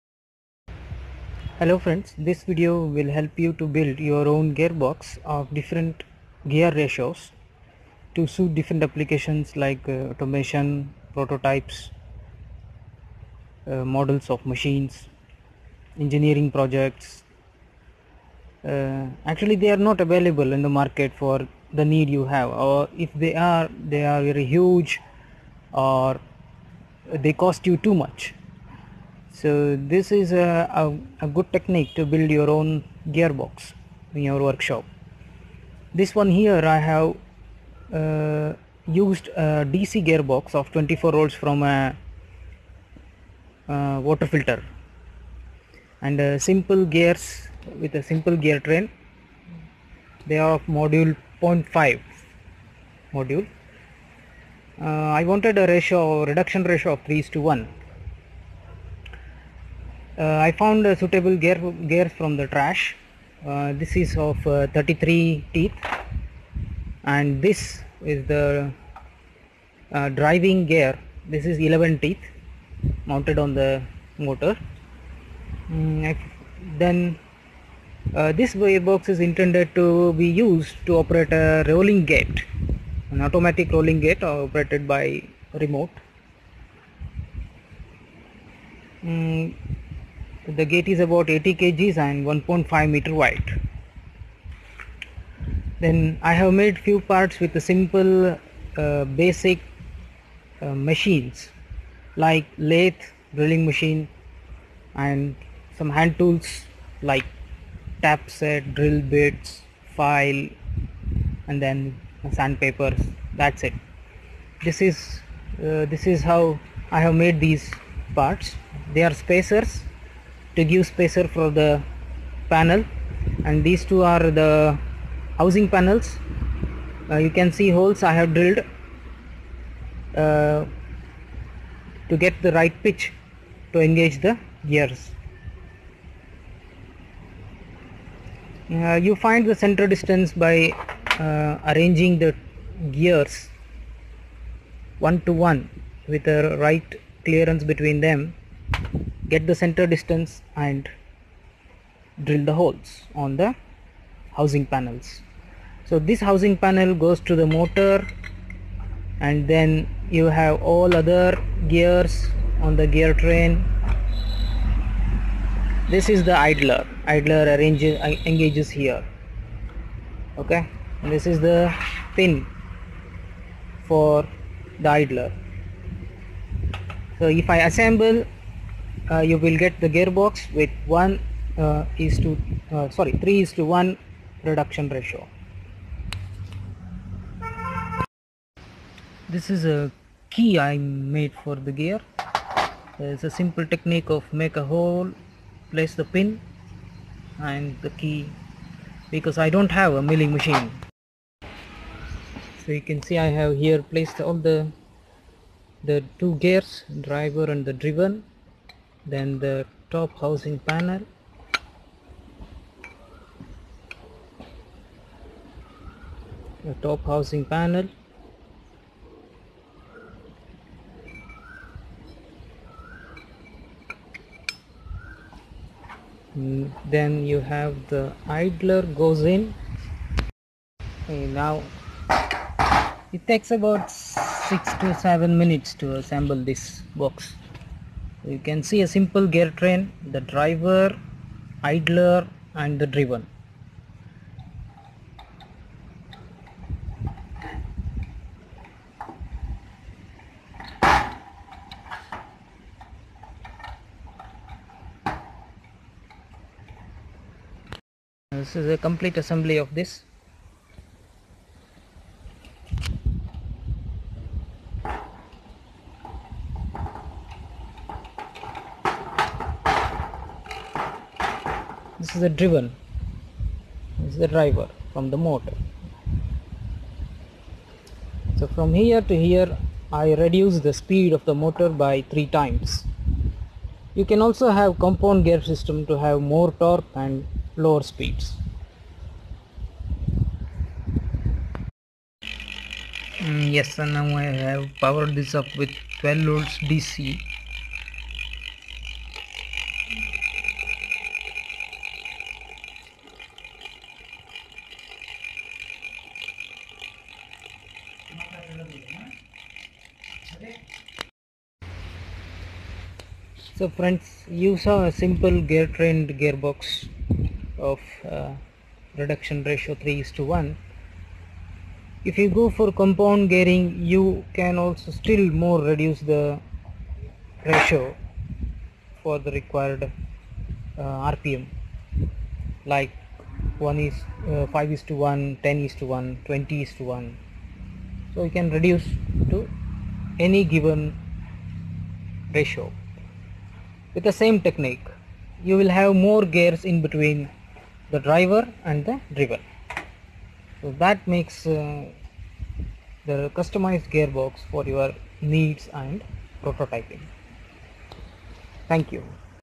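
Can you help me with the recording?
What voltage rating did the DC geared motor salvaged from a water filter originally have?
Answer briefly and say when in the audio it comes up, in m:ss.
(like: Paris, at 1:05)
24 volts, at 0:40.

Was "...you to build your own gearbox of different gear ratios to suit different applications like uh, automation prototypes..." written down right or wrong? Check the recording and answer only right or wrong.
right.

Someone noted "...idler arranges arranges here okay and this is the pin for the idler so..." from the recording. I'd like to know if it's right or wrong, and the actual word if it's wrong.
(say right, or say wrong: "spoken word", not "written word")
wrong: "engages", not "arranges".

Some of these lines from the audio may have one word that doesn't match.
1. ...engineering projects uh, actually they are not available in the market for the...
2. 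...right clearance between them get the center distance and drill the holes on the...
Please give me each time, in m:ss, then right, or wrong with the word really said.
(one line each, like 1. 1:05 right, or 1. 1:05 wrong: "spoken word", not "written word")
1. 0:15 right
2. 2:26 right.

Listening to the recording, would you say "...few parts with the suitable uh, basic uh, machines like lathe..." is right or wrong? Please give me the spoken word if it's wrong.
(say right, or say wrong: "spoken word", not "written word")
wrong: "simple", not "suitable".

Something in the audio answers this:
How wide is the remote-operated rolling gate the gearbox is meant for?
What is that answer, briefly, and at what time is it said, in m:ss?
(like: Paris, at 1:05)
1.5 meters, at 1:32.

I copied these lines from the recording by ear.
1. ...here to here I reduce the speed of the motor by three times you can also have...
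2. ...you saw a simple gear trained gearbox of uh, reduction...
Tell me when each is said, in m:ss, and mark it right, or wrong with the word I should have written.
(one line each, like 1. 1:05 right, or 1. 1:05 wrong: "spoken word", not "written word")
1. 4:38 right
2. 5:14 right.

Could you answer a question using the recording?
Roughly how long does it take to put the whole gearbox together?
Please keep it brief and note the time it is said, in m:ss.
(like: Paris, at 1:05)
6 to 7 minutes, at 3:53.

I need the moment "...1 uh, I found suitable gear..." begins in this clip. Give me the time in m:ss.
0:57.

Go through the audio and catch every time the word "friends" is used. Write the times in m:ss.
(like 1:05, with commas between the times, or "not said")
0:01, 5:13.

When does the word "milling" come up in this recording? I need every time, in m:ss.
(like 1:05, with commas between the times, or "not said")
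3:20.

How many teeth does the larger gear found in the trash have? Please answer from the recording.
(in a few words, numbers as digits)
33.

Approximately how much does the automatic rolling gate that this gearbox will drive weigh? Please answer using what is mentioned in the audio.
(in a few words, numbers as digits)
80 kg.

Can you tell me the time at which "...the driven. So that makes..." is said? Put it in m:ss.
5:48.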